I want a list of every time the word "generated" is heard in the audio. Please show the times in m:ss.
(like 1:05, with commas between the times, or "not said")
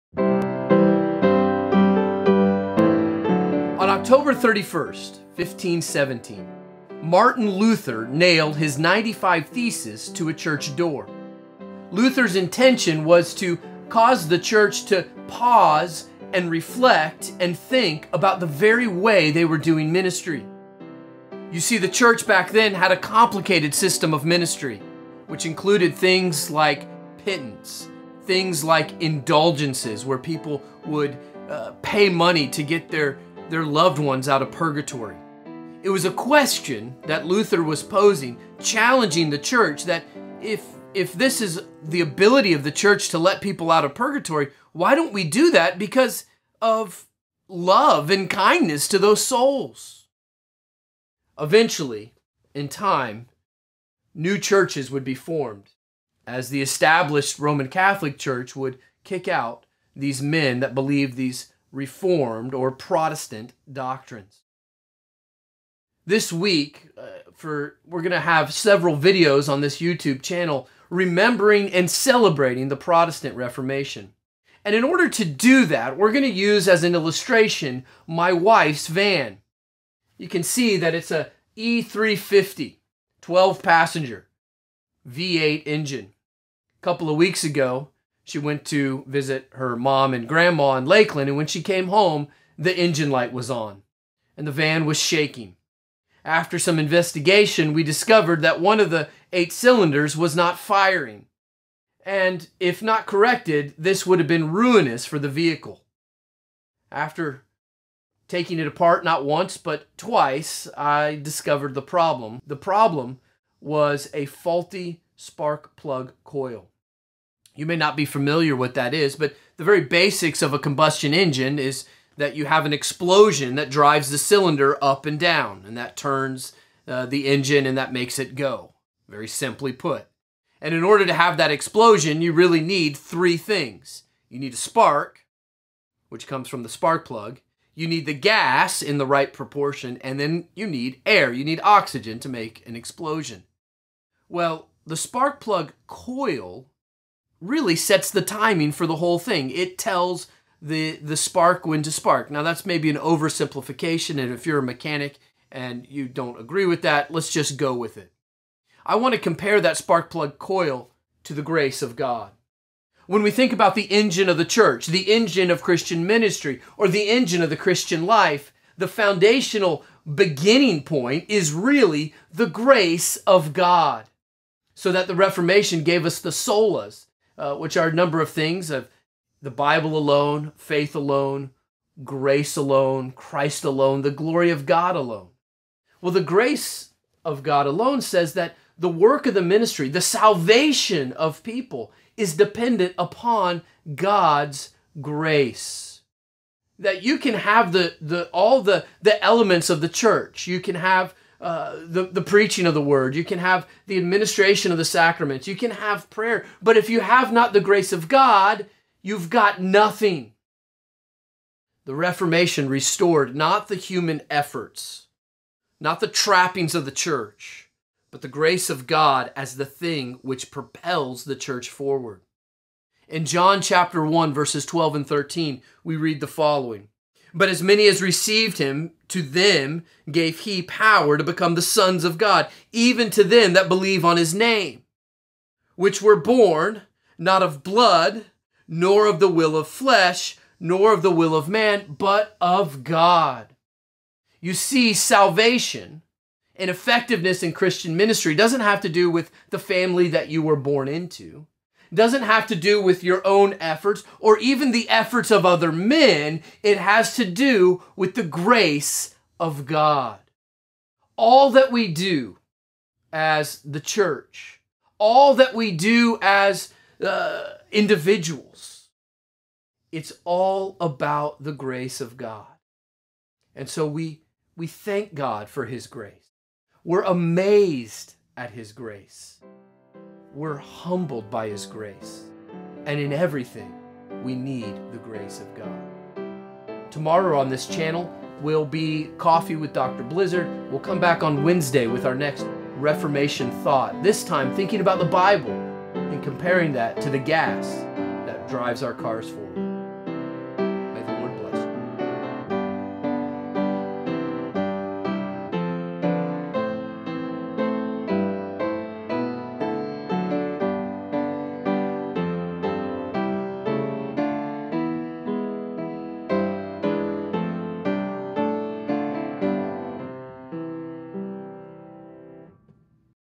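not said.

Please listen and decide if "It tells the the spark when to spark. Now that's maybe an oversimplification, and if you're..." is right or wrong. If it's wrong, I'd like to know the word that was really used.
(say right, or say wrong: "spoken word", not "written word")
right.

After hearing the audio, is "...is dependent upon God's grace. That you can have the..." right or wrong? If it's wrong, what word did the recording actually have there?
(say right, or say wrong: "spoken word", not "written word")
right.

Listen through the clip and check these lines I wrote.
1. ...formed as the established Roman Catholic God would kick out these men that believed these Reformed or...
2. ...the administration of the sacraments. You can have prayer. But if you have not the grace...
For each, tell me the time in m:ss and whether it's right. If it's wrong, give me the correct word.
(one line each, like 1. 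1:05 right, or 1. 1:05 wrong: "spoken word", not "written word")
1. 0:55 wrong: "Church", not "God"
2. 3:23 right.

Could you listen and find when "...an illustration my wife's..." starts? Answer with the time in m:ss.
1:16.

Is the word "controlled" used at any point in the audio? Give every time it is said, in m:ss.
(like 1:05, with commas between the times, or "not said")
not said.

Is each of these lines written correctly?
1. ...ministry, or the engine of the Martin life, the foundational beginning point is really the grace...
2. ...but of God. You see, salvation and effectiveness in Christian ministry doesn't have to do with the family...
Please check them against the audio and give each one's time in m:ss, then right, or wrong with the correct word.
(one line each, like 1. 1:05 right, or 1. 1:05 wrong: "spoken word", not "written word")
1. 2:46 wrong: "Christian", not "Martin"
2. 4:01 right.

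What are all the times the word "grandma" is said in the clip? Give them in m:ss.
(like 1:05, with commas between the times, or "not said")
1:30.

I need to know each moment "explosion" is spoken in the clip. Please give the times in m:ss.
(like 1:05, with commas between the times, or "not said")
2:02, 2:11, 2:22.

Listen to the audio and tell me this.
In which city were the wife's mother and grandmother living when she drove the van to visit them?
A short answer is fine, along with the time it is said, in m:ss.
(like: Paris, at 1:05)
Lakeland, at 1:30.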